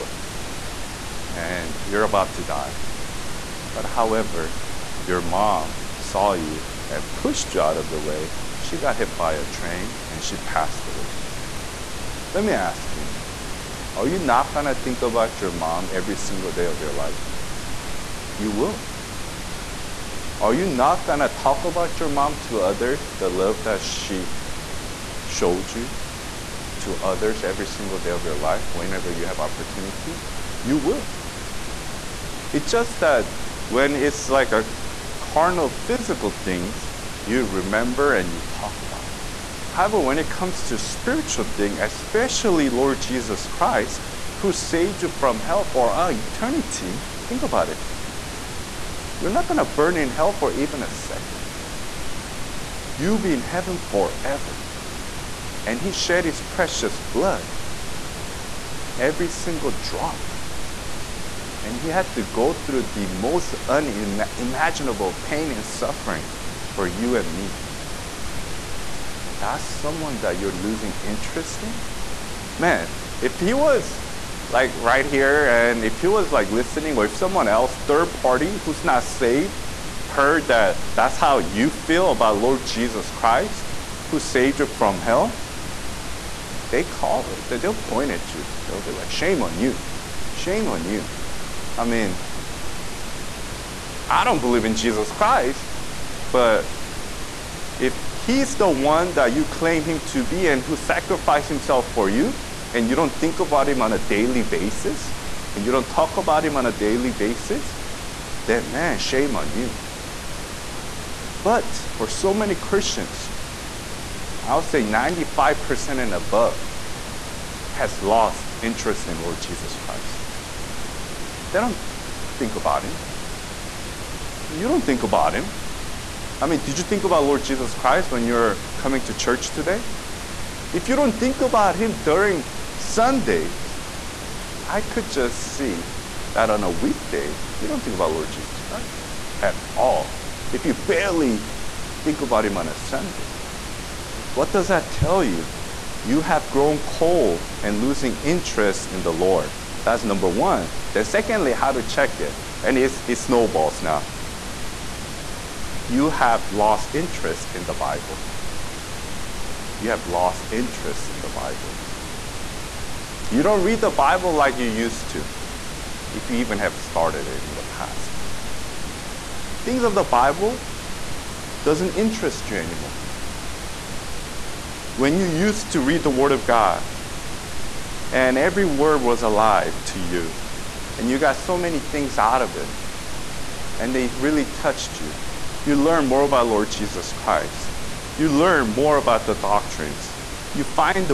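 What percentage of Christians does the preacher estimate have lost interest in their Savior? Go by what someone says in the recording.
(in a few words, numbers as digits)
95% and above.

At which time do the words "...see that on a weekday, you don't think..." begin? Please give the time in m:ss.
2:15.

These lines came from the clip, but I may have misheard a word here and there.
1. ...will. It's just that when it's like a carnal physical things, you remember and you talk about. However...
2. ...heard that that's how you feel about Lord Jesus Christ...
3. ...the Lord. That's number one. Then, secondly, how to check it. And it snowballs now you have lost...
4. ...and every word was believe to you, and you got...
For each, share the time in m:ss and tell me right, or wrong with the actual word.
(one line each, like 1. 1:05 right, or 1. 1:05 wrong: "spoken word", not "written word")
1. 0:30 right
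2. 1:20 right
3. 2:29 right
4. 2:58 wrong: "alive", not "believe".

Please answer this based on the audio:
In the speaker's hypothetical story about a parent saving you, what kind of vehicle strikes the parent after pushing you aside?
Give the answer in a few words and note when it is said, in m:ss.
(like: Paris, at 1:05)
train, at 0:09.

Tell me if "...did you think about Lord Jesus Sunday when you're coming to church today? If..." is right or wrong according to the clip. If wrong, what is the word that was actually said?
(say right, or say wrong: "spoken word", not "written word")
wrong: "Christ", not "Sunday".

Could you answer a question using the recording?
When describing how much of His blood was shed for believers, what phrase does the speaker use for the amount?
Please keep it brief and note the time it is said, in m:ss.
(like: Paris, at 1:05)
every single drop, at 0:58.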